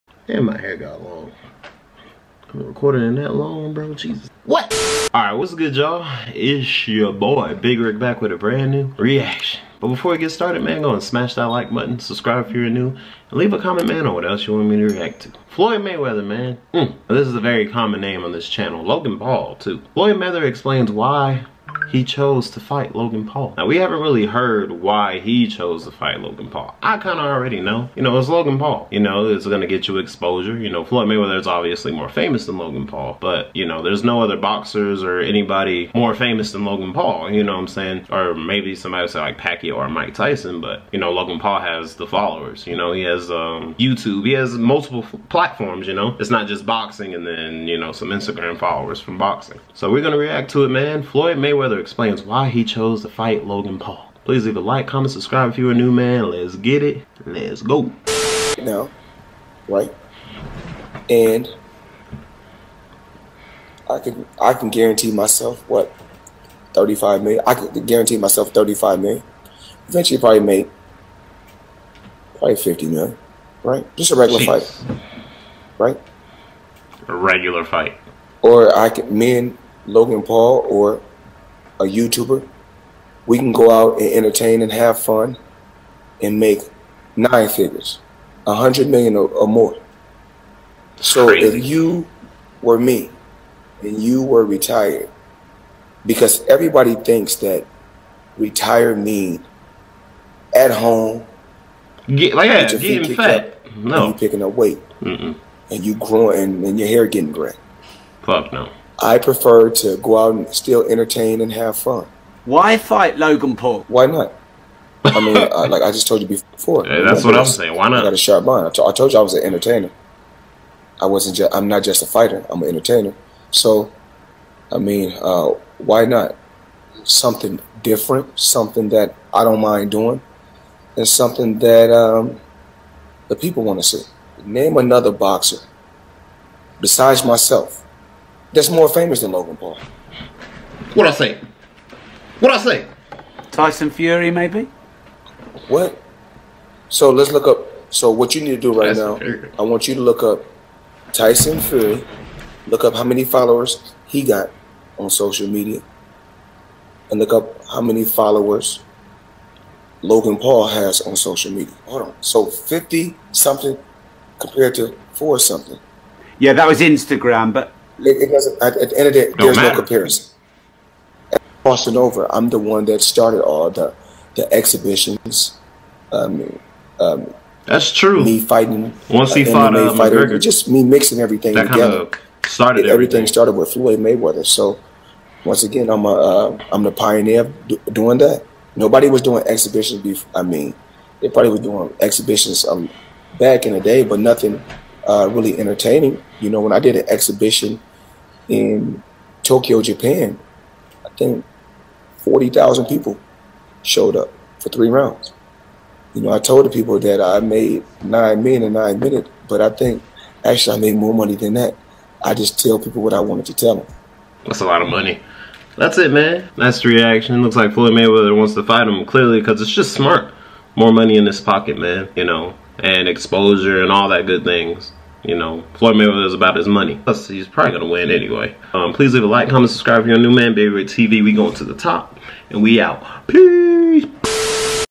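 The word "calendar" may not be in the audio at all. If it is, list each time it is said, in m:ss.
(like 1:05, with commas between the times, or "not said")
not said.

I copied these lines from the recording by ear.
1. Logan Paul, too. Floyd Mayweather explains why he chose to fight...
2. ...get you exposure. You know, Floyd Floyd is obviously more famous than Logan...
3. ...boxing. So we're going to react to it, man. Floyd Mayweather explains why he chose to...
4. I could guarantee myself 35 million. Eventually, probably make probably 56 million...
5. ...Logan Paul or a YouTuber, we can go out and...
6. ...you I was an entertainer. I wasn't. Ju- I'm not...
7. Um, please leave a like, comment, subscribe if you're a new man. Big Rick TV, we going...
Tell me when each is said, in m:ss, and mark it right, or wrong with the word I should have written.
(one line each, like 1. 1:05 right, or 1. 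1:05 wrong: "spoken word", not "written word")
1. 0:18 right
2. 0:29 wrong: "Mayweather", not "Floyd"
3. 0:49 right
4. 1:07 wrong: "50", not "56"
5. 1:19 right
6. 1:59 right
7. 3:48 right.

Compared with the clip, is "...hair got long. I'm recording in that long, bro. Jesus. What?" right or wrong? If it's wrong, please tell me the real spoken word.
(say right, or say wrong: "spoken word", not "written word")
right.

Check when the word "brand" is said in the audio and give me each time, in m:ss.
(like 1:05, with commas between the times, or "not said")
0:08.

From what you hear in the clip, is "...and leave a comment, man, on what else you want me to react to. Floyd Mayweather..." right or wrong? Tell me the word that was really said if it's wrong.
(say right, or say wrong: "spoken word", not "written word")
right.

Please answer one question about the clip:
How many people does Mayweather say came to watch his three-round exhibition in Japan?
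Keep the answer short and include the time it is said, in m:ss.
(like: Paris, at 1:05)
40,000, at 3:22.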